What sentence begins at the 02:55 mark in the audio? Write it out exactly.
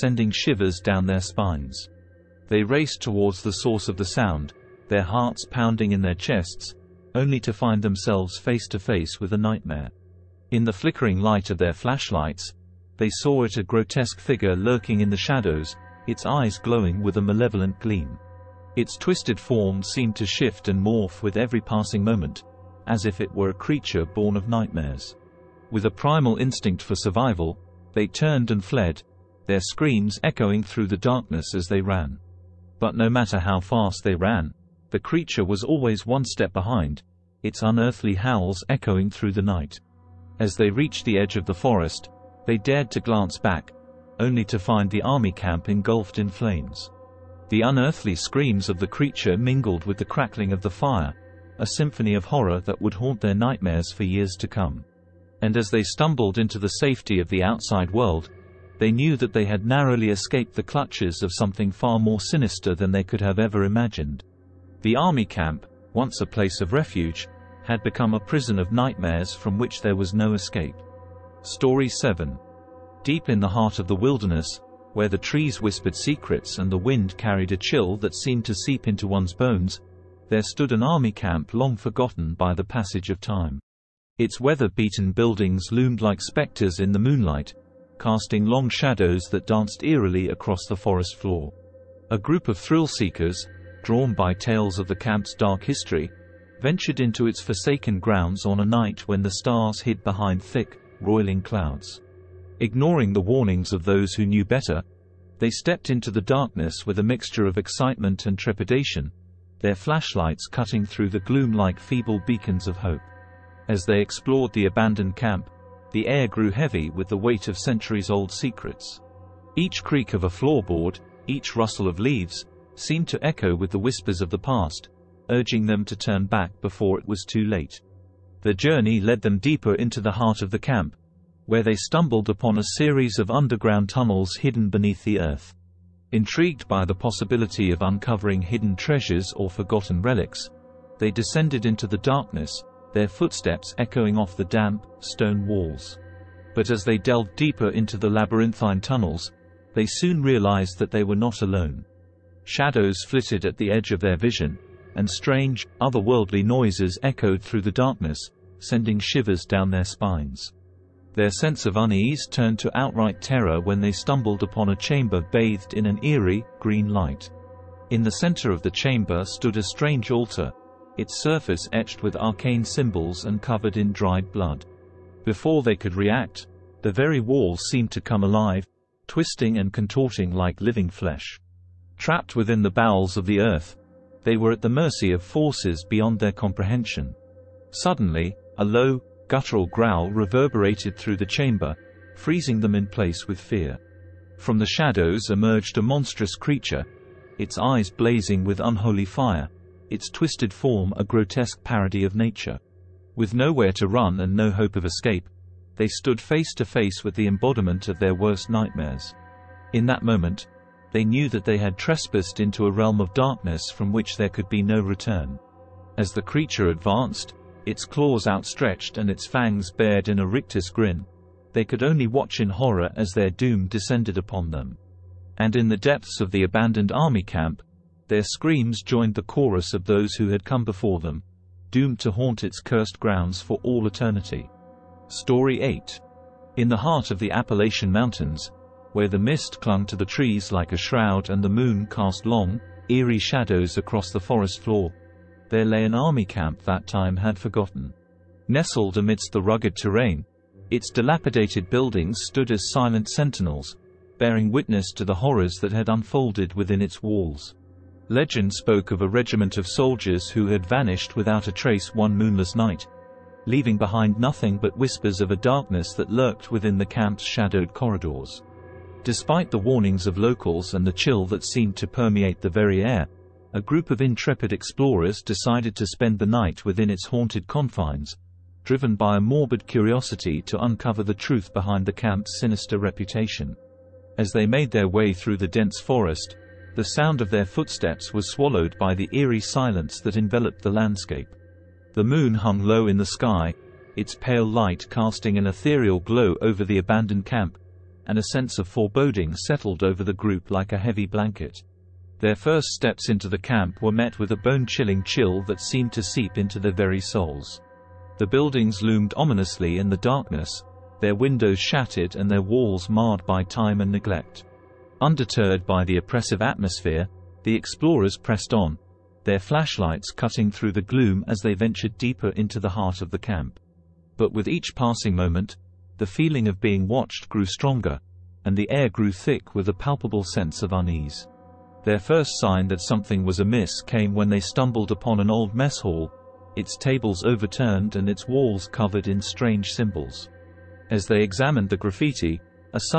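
Before they could react, the very walls seemed to come alive, twisting and contorting like living flesh.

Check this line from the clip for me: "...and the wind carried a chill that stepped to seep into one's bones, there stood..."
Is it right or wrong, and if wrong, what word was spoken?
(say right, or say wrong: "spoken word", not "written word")
wrong: "seemed", not "stepped".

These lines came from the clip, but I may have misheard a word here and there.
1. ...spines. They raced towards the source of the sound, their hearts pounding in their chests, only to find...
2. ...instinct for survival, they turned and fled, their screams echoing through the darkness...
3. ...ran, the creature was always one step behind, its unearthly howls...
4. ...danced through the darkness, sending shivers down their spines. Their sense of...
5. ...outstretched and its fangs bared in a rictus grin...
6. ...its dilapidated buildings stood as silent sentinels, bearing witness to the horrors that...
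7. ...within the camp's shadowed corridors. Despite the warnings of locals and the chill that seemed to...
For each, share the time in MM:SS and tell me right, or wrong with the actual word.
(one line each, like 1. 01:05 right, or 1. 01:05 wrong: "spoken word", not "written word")
1. 00:01 right
2. 00:26 right
3. 00:34 right
4. 02:37 wrong: "echoed", not "danced"
5. 03:38 right
6. 04:10 right
7. 04:26 right.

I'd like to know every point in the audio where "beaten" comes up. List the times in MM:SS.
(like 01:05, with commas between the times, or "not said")
01:24.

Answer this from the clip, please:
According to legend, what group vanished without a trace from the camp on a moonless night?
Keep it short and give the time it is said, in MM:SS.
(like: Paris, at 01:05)
a regiment of soldiers, at 04:19.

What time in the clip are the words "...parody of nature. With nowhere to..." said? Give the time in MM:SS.
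03:21.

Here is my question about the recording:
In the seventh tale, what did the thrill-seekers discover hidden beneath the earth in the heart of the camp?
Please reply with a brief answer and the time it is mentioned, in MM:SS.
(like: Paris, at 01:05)
underground tunnels, at 02:13.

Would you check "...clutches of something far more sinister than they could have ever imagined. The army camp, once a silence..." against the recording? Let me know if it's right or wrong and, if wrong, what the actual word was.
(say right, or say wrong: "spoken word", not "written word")
wrong: "place", not "silence".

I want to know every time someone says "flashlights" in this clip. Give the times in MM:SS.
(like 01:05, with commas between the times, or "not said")
00:11, 01:49, 05:19.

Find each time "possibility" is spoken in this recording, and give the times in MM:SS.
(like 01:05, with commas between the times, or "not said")
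02:16.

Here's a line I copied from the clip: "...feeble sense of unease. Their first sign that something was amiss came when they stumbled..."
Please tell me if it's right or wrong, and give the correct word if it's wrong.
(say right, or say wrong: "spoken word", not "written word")
wrong: "palpable", not "feeble".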